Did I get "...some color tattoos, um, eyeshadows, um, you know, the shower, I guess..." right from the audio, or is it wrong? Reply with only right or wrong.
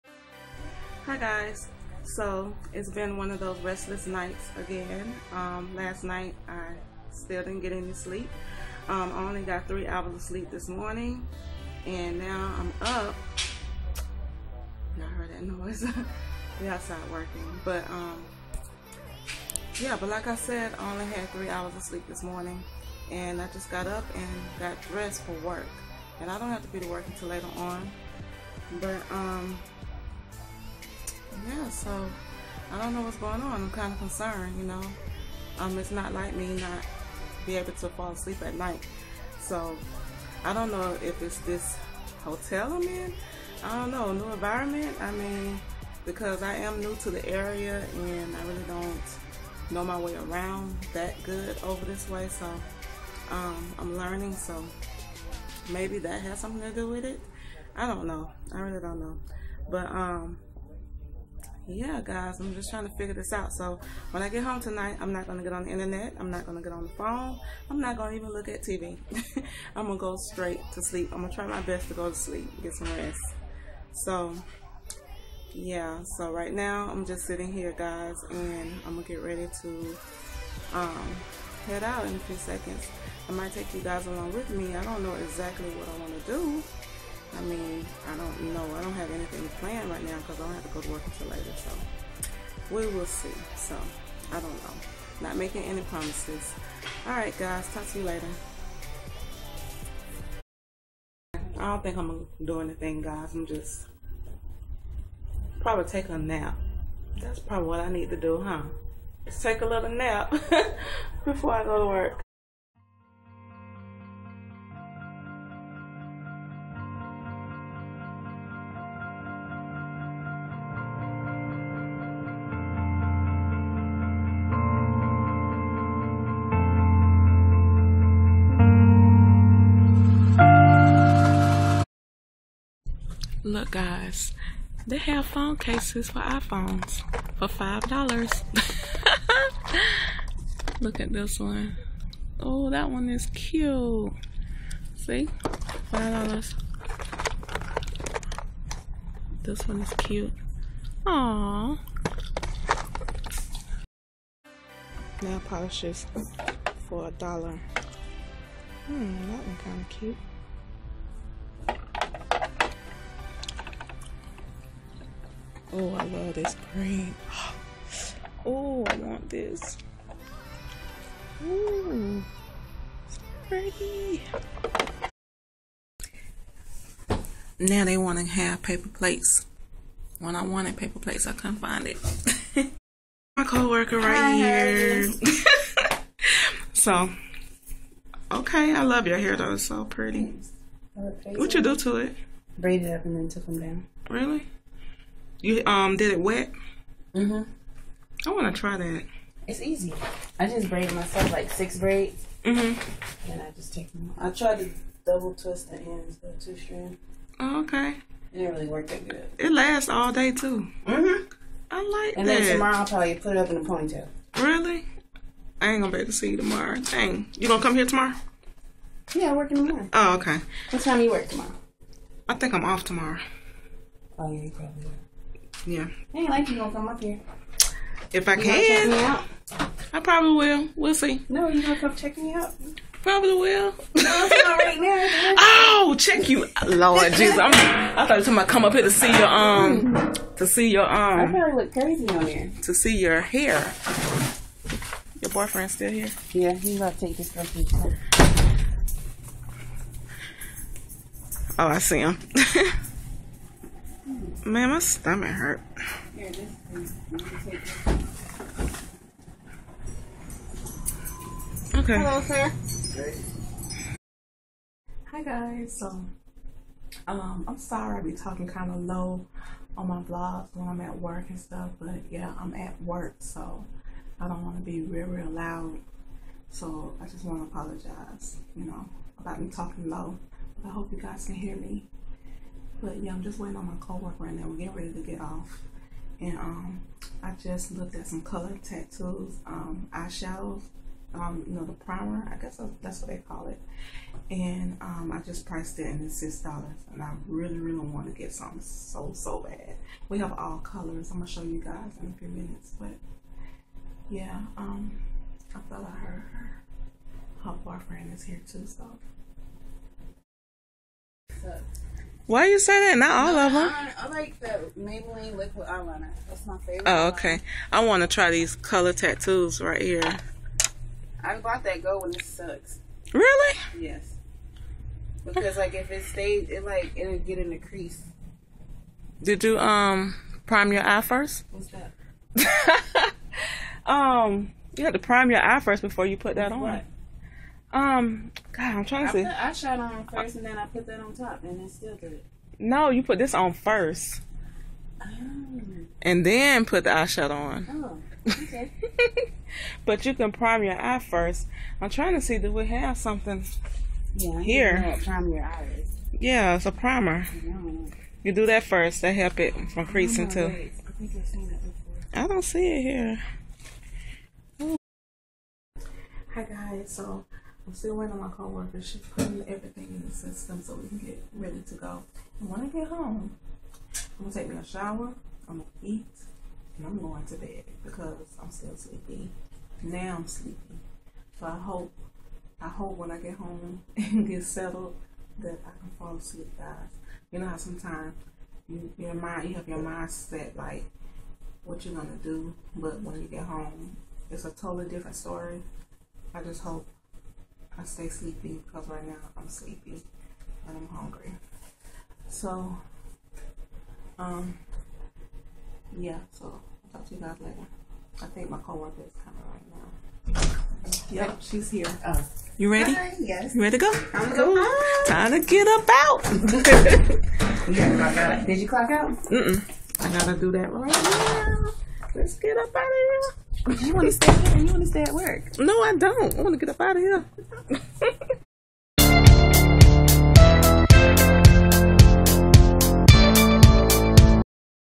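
wrong.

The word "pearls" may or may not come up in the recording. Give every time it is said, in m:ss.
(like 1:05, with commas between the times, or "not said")
not said.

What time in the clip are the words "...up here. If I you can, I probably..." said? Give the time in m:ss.
3:46.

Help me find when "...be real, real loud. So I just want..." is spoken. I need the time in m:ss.
4:34.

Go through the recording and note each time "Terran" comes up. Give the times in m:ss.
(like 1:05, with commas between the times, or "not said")
not said.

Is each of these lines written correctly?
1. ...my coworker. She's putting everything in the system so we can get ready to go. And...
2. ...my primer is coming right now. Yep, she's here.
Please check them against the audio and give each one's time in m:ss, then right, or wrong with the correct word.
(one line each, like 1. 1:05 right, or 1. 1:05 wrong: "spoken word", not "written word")
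1. 6:08 right
2. 6:48 wrong: "coworker", not "primer".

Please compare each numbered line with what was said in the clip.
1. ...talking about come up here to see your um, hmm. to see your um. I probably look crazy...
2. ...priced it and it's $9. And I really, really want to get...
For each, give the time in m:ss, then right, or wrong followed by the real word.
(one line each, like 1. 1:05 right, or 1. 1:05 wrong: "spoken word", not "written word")
1. 3:58 right
2. 4:55 wrong: "6", not "9".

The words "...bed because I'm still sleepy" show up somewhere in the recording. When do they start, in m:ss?
6:17.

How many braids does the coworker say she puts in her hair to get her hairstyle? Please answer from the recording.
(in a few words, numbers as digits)
6.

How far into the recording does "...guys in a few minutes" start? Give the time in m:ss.
5:01.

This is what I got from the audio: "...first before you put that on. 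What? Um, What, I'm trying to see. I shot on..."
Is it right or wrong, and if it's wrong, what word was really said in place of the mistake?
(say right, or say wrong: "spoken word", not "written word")
wrong: "God", not "What".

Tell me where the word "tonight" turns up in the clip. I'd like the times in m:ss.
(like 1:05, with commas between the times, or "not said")
1:04.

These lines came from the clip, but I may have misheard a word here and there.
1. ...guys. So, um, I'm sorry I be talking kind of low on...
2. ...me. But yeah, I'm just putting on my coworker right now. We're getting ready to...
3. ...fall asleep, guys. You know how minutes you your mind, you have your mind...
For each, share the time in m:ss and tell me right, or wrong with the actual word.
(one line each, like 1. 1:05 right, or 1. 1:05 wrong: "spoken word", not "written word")
1. 4:25 right
2. 4:41 wrong: "waiting", not "putting"
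3. 6:25 wrong: "sometimes", not "minutes".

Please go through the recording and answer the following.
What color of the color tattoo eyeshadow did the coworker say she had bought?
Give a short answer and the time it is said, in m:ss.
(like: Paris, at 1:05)
Gold, at 5:21.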